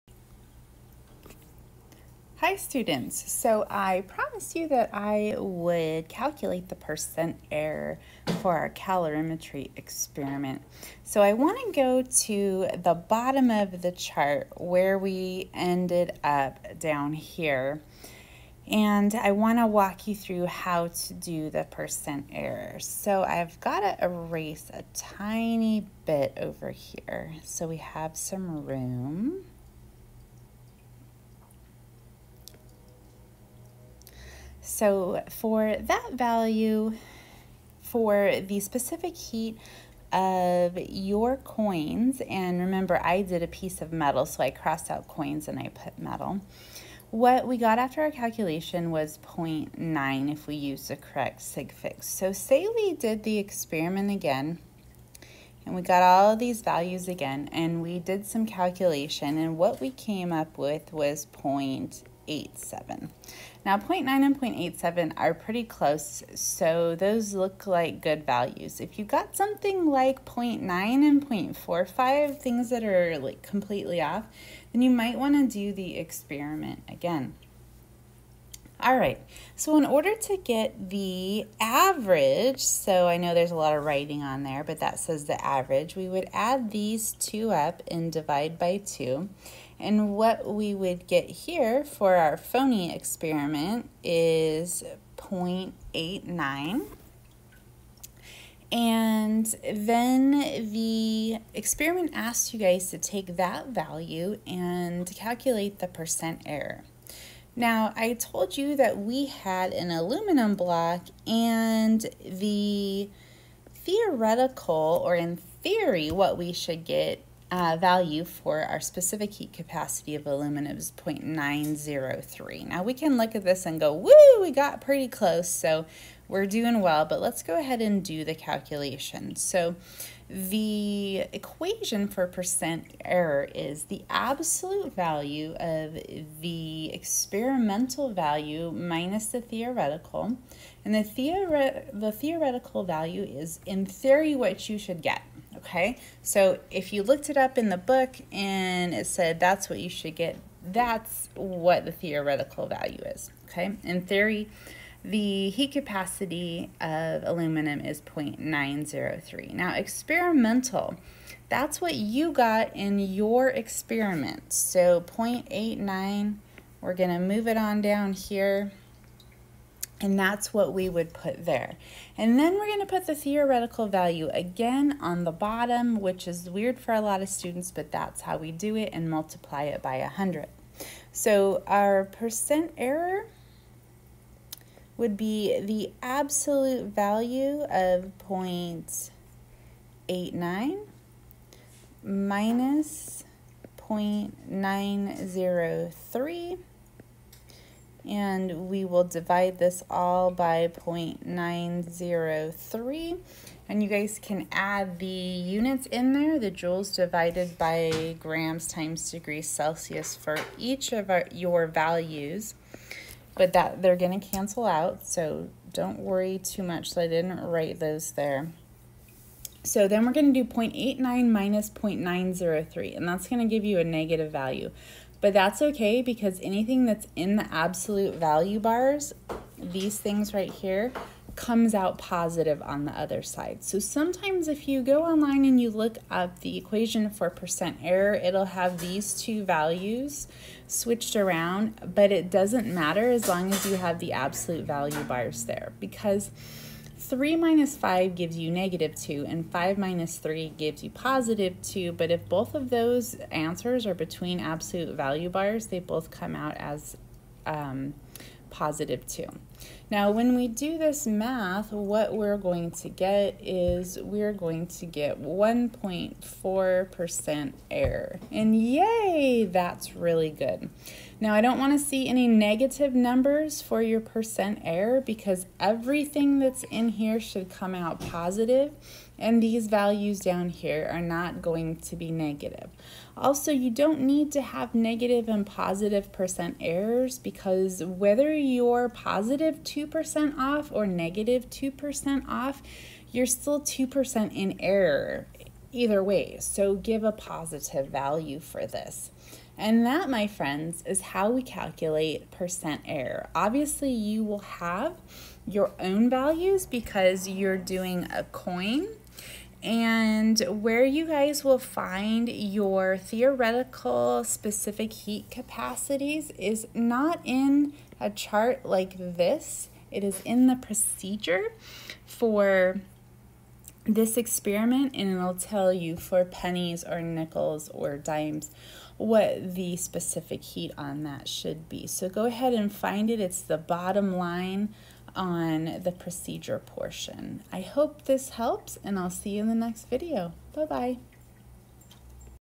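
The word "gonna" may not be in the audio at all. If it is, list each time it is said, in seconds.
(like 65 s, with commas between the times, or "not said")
166 s, 172 s.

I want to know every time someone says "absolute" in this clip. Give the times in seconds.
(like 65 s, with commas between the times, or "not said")
134 s, 186 s, 227 s, 244 s, 254 s.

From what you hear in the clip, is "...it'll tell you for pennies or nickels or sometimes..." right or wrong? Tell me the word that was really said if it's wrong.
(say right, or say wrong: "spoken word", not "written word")
wrong: "dimes", not "sometimes".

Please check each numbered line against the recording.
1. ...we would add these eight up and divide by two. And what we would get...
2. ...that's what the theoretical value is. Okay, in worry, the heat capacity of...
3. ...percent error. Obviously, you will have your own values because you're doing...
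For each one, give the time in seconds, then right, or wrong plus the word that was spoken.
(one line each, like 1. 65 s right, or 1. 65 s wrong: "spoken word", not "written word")
1. 85 s wrong: "two", not "eight"
2. 150 s wrong: "theory", not "worry"
3. 302 s right.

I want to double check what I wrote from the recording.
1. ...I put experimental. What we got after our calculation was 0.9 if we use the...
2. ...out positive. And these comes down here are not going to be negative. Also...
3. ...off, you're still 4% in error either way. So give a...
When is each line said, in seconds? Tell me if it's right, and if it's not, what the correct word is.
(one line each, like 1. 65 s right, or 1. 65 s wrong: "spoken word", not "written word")
1. 45 s wrong: "metal", not "experimental"
2. 277 s wrong: "values", not "comes"
3. 292 s wrong: "2", not "4".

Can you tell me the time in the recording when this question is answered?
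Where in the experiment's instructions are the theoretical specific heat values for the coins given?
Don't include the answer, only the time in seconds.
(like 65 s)
333 s.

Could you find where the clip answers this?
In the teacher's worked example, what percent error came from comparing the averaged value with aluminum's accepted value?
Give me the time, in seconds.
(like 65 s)
265 s.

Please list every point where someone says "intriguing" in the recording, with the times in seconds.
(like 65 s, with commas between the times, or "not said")
not said.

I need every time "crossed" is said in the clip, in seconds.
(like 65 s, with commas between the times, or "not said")
44 s.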